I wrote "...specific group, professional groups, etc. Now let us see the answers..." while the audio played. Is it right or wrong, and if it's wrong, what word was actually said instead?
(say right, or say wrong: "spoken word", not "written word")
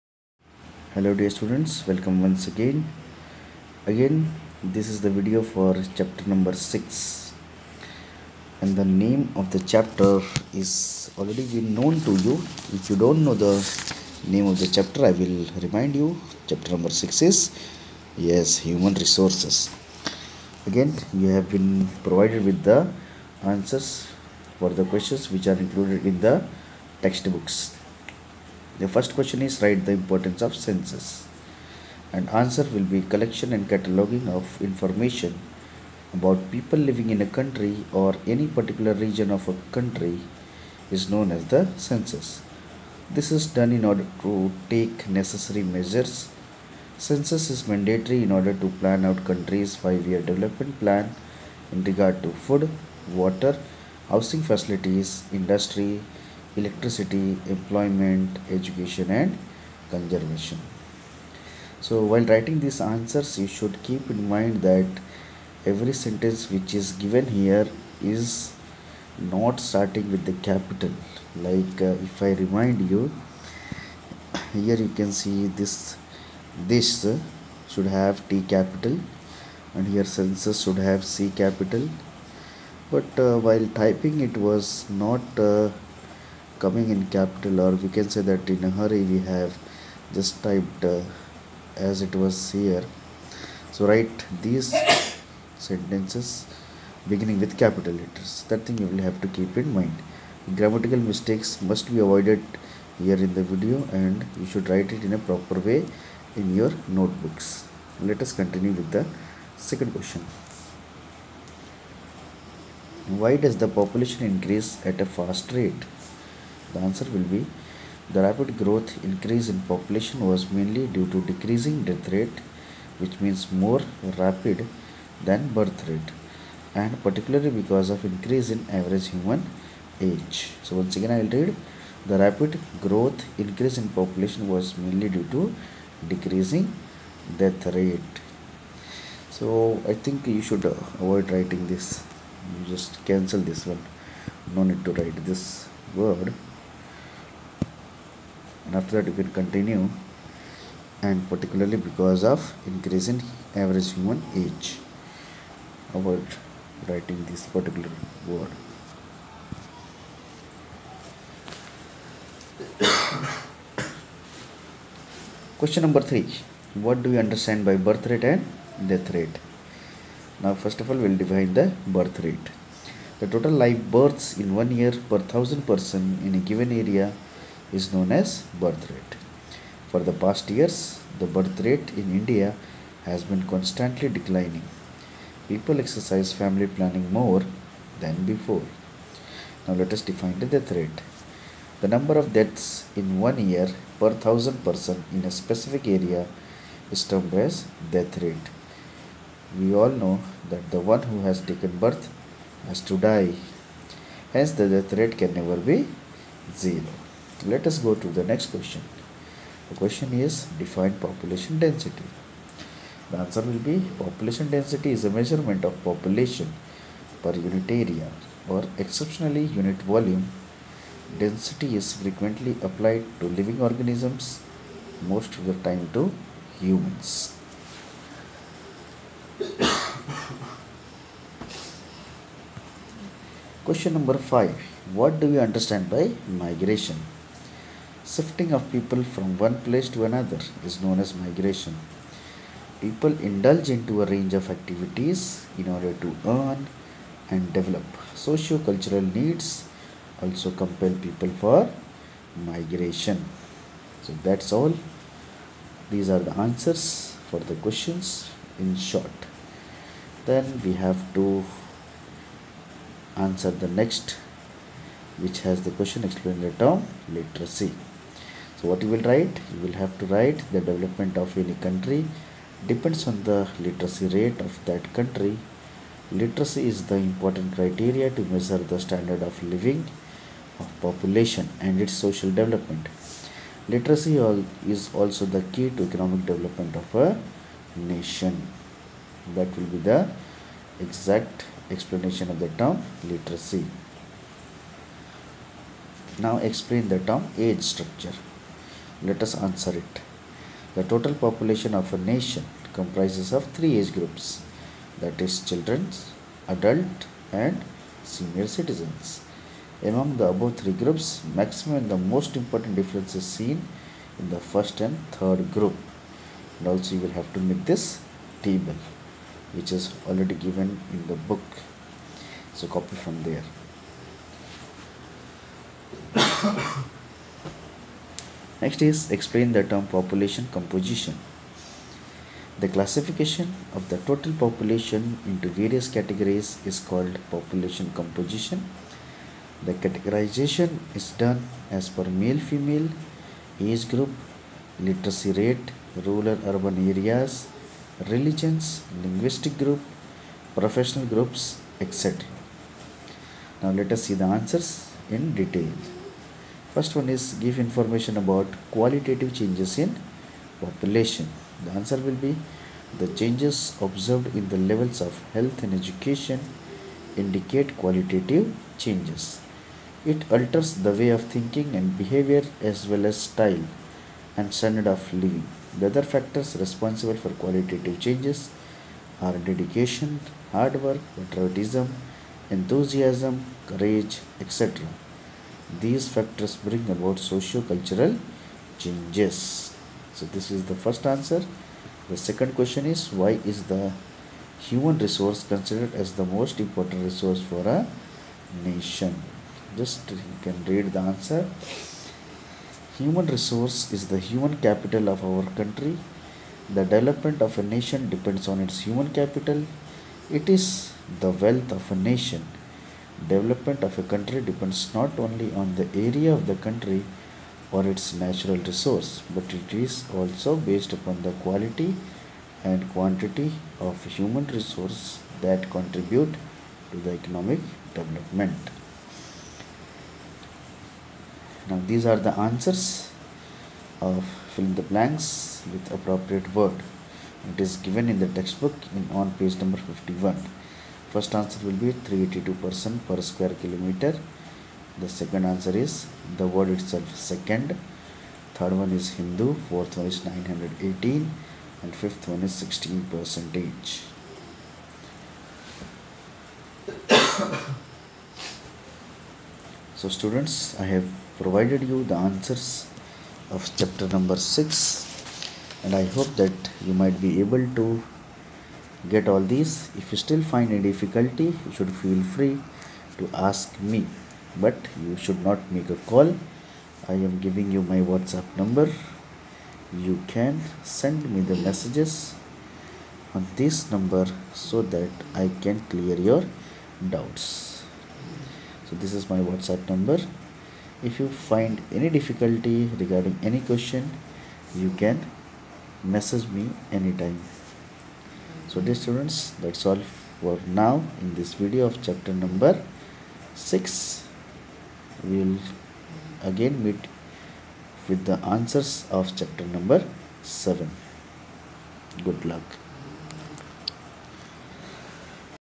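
wrong: "linguistic", not "specific".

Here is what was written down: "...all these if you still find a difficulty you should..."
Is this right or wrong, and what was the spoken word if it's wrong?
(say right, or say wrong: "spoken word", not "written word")
right.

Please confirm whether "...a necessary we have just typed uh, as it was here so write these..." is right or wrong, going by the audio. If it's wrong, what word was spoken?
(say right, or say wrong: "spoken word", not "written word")
wrong: "hurry", not "necessary".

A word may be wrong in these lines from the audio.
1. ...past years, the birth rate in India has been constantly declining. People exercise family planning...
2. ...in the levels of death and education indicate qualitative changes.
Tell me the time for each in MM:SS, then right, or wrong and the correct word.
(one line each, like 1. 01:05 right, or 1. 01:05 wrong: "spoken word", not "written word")
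1. 03:00 right
2. 06:04 wrong: "health", not "death".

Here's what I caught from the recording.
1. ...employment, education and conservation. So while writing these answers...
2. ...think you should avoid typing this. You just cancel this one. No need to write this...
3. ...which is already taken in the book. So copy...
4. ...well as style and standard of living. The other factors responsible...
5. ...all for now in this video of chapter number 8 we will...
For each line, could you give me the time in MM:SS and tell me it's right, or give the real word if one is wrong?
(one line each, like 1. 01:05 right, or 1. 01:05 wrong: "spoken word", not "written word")
1. 00:57 right
2. 02:20 wrong: "writing", not "typing"
3. 05:19 wrong: "given", not "taken"
4. 06:12 right
5. 08:19 wrong: "6", not "8".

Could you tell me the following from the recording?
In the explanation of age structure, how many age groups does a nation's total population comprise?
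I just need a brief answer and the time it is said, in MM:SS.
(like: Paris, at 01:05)
3, at 05:03.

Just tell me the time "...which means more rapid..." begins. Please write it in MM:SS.
02:02.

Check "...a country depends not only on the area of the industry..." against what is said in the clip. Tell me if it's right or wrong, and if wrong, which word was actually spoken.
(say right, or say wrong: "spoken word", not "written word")
wrong: "country", not "industry".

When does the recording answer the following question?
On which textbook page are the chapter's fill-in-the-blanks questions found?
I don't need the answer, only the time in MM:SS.
07:19.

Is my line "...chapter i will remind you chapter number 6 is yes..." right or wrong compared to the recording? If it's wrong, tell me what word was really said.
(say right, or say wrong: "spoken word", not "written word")
right.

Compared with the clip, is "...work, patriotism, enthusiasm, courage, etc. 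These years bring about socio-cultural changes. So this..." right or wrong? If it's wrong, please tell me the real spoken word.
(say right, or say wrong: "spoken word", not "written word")
wrong: "factors", not "years".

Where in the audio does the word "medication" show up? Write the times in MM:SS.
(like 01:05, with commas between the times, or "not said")
not said.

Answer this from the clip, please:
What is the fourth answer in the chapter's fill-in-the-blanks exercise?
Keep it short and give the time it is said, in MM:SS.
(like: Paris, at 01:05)
918, at 07:30.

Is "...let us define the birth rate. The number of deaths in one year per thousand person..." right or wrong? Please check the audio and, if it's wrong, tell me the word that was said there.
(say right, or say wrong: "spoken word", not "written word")
wrong: "death", not "birth".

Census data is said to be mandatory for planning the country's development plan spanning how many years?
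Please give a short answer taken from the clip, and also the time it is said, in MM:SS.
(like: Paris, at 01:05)
5, at 00:49.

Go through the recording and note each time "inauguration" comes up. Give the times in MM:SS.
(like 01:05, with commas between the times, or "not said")
not said.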